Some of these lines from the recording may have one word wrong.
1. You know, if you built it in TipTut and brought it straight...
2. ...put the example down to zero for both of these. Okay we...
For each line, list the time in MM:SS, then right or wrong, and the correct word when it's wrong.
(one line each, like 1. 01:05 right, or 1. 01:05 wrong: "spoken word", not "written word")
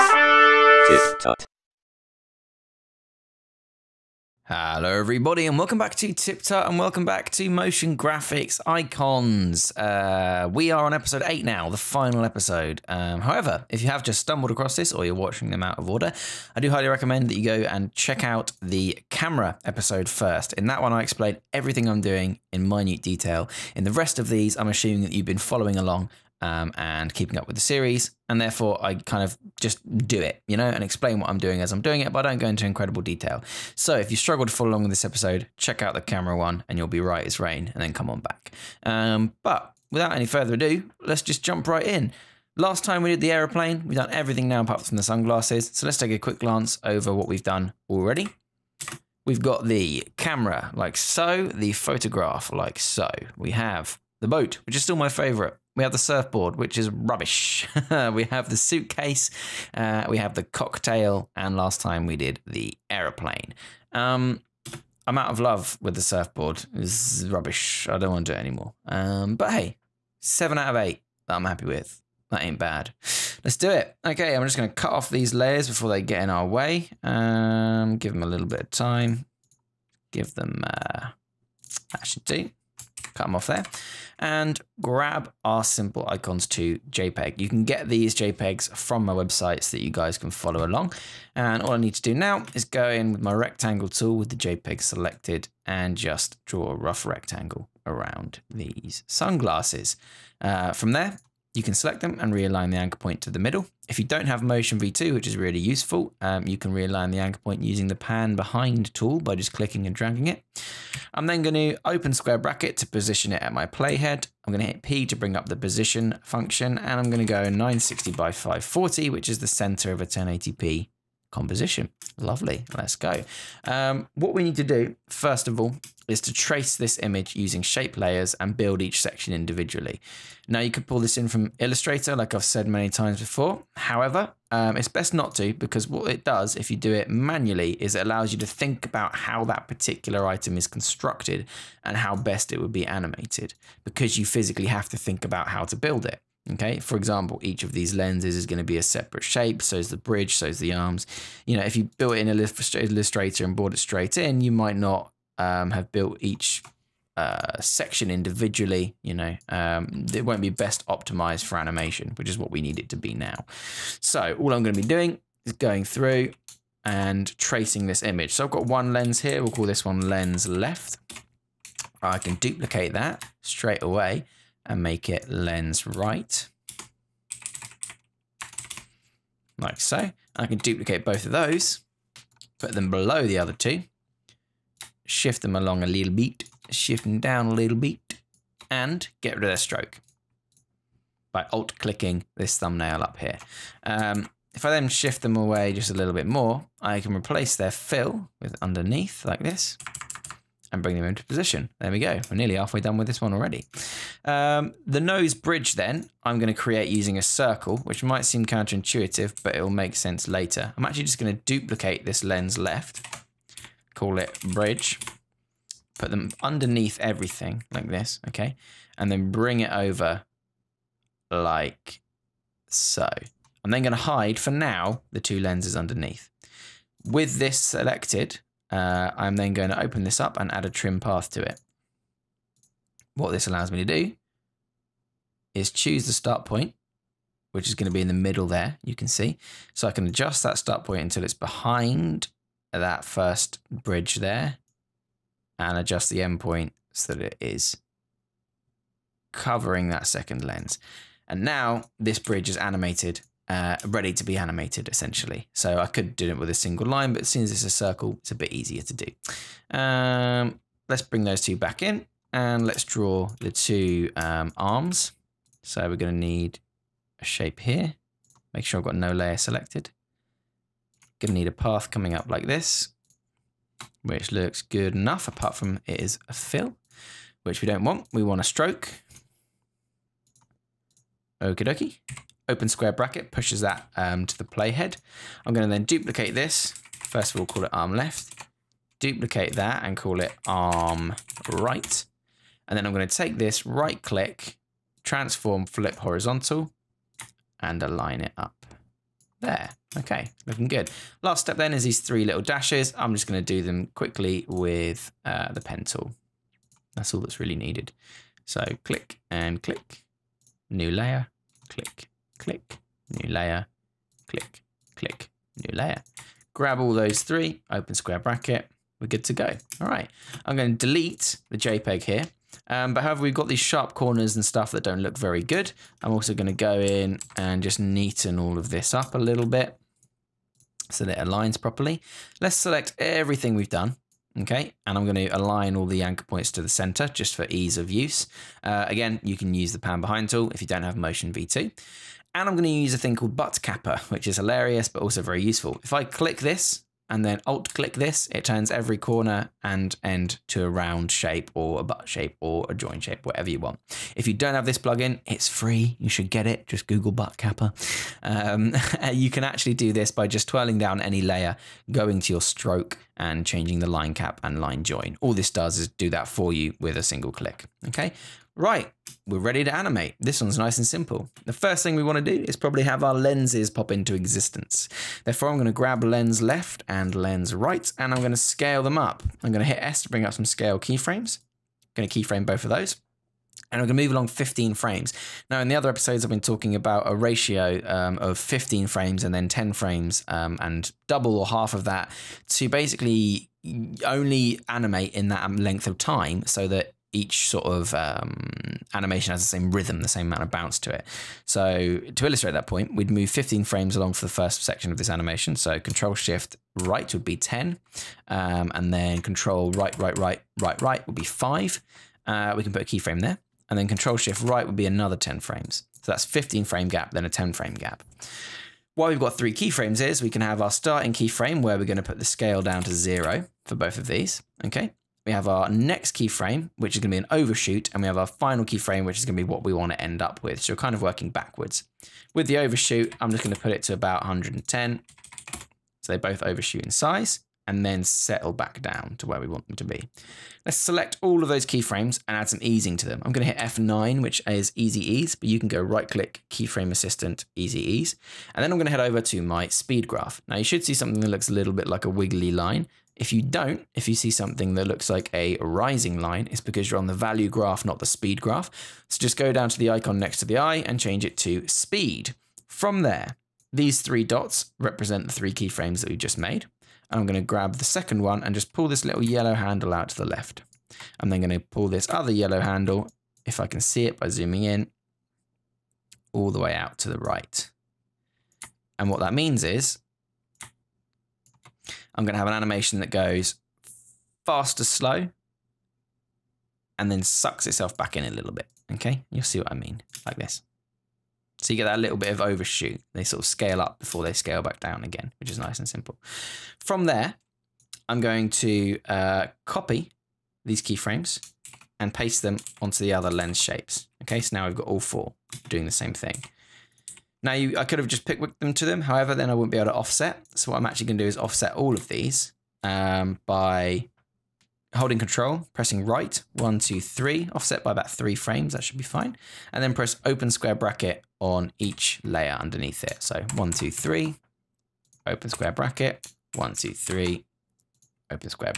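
1. 02:31 wrong: "Illustrator", not "TipTut"
2. 07:02 wrong: "scale", not "example".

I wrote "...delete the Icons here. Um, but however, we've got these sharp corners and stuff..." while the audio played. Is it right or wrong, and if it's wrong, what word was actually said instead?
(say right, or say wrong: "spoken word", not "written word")
wrong: "JPEG", not "Icons".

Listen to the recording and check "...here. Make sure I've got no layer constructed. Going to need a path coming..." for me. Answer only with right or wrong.
wrong.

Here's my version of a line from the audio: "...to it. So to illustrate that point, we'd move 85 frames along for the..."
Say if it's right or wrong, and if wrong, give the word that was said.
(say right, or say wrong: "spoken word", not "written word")
wrong: "15", not "85".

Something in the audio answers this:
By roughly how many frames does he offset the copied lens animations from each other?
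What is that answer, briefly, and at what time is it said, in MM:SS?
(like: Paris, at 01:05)
3, at 08:38.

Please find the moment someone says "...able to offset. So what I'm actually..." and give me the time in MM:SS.
08:29.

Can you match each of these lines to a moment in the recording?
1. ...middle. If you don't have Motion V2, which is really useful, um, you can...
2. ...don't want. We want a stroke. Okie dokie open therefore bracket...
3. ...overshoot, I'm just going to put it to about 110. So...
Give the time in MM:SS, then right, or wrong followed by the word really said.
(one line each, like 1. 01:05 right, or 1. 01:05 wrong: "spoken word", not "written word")
1. 01:43 right
2. 04:37 wrong: "square", not "therefore"
3. 07:12 right.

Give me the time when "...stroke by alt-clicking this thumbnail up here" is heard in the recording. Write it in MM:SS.
03:09.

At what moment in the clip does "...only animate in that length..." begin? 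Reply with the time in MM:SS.
06:34.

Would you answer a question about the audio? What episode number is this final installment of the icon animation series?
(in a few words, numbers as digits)
8.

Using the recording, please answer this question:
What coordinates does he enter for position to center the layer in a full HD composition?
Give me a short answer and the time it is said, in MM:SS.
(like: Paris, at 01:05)
960 by 540, at 01:57.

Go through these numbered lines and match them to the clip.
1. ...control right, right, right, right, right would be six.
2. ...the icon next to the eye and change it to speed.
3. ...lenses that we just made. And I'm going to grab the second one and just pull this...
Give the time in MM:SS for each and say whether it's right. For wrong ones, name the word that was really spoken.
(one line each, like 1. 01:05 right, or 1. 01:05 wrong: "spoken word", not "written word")
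1. 06:49 wrong: "five", not "six"
2. 07:39 right
3. 07:45 wrong: "keyframes", not "lenses".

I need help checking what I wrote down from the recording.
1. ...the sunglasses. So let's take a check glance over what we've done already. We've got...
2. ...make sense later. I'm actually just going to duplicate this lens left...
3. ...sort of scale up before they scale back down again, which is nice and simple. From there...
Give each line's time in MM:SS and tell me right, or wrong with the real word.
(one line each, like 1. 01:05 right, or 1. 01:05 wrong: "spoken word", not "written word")
1. 00:44 wrong: "quick", not "check"
2. 03:29 right
3. 08:13 right.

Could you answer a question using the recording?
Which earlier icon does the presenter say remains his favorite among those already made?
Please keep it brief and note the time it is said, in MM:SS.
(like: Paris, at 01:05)
the boat, at 00:54.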